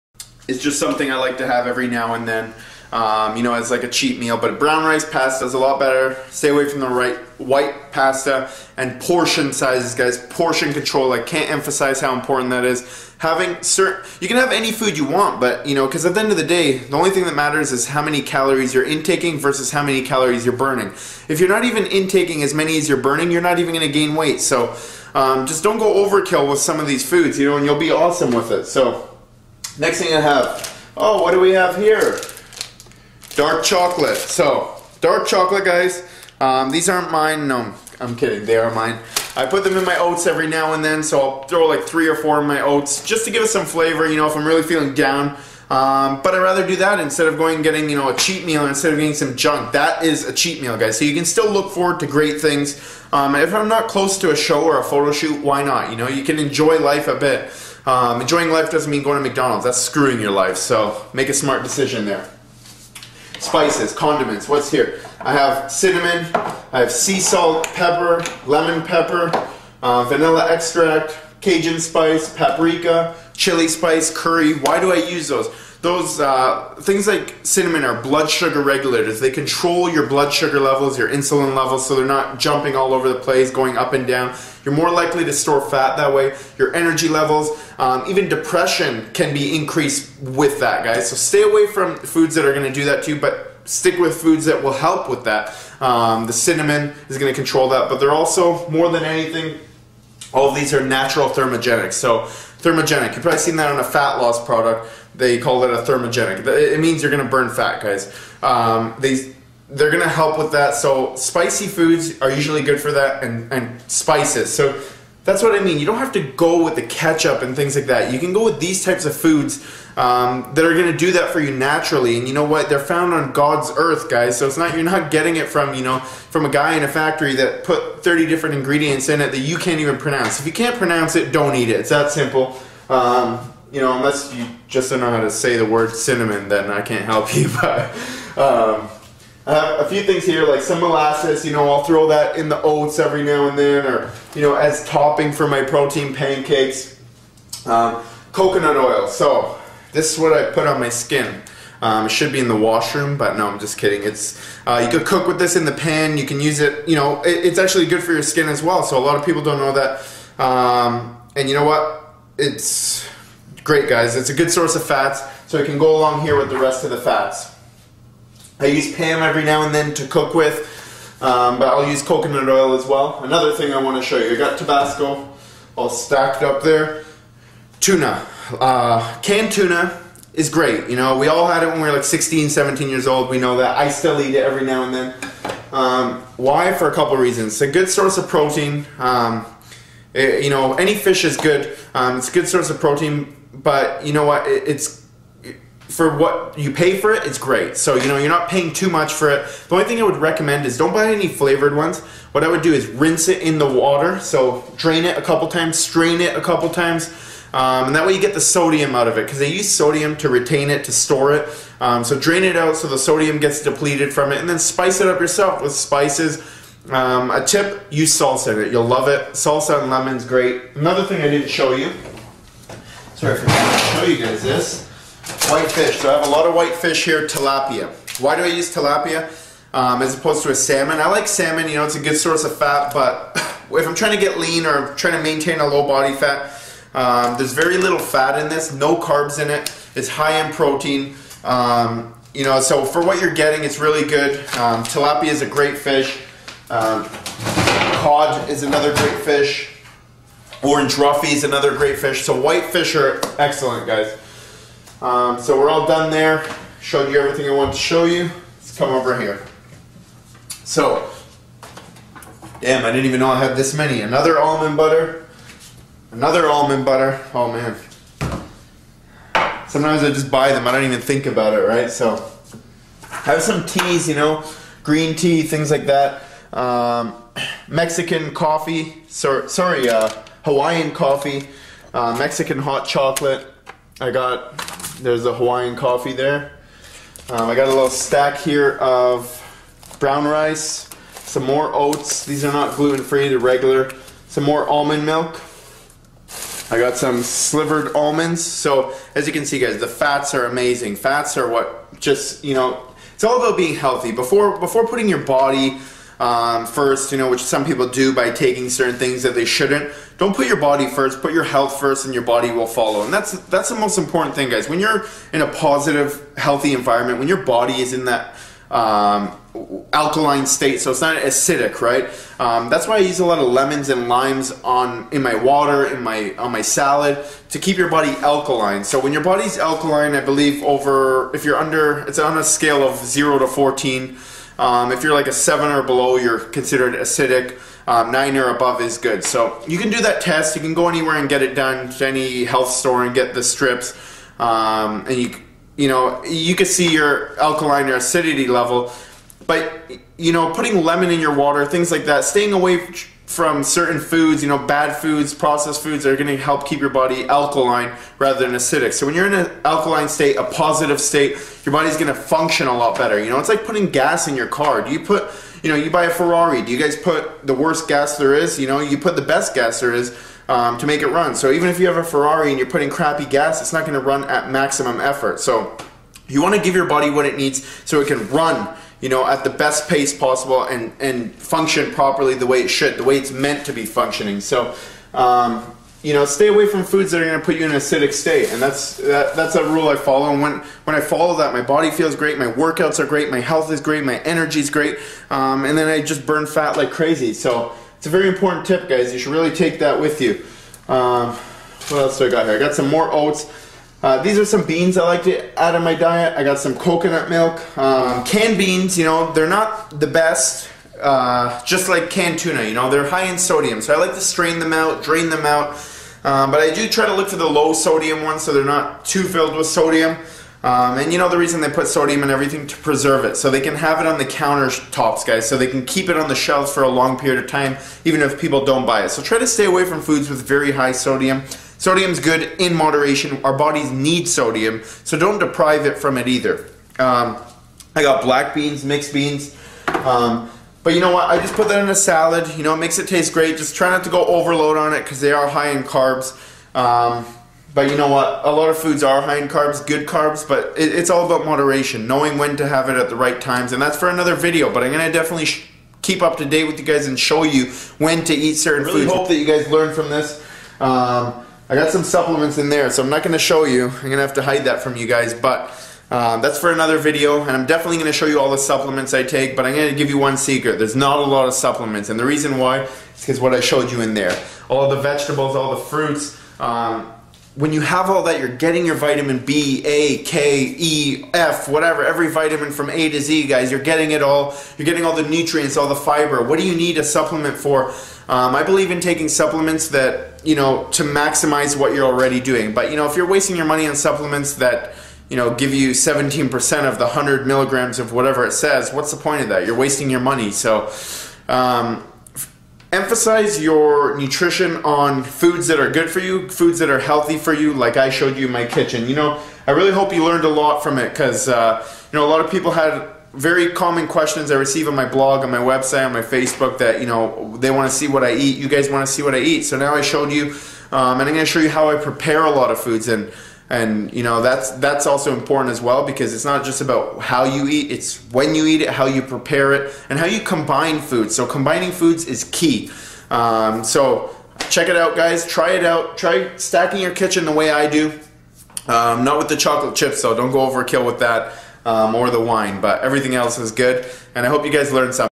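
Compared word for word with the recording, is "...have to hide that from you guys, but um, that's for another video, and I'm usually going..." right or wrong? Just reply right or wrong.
wrong.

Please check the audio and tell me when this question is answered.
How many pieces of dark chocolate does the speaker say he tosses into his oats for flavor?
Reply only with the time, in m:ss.
0:41.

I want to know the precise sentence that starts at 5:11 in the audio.
Put your health first, and your body will follow.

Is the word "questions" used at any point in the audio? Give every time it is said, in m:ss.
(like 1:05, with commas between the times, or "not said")
8:34.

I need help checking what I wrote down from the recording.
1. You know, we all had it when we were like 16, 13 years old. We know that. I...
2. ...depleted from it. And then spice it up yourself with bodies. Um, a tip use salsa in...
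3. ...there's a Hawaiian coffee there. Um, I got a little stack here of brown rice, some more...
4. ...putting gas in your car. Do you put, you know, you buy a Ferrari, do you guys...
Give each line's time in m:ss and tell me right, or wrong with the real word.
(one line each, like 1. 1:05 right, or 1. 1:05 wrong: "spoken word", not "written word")
1. 3:00 wrong: "17", not "13"
2. 3:33 wrong: "spices", not "bodies"
3. 4:45 right
4. 6:03 right.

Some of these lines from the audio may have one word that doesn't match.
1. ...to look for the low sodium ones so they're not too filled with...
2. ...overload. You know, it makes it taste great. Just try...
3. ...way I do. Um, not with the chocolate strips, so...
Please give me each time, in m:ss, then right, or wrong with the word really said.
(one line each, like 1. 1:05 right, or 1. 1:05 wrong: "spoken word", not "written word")
1. 6:57 right
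2. 7:21 wrong: "salad", not "overload"
3. 8:57 wrong: "chips", not "strips".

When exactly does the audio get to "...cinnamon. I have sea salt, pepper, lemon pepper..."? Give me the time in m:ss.
1:05.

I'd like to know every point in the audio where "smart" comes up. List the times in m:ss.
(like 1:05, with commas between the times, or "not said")
1:01.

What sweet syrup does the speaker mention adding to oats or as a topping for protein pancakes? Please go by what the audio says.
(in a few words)
molasses.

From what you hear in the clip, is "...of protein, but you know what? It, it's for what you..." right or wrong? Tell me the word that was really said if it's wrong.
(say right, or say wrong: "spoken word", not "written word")
right.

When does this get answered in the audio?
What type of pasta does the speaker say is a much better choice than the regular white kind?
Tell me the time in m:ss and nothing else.
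0:04.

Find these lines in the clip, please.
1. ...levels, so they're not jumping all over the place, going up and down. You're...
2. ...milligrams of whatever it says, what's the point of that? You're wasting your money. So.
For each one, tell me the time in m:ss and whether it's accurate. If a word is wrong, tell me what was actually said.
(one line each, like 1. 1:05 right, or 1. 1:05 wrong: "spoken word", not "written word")
1. 1:21 right
2. 8:17 right.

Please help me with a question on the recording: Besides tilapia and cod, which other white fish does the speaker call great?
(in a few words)
orange roughy.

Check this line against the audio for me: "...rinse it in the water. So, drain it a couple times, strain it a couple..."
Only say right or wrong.
right.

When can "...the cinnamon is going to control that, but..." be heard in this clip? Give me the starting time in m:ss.
1:36.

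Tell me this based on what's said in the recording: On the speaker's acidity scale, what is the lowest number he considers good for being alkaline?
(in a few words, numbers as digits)
9.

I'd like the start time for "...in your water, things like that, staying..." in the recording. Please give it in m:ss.
5:51.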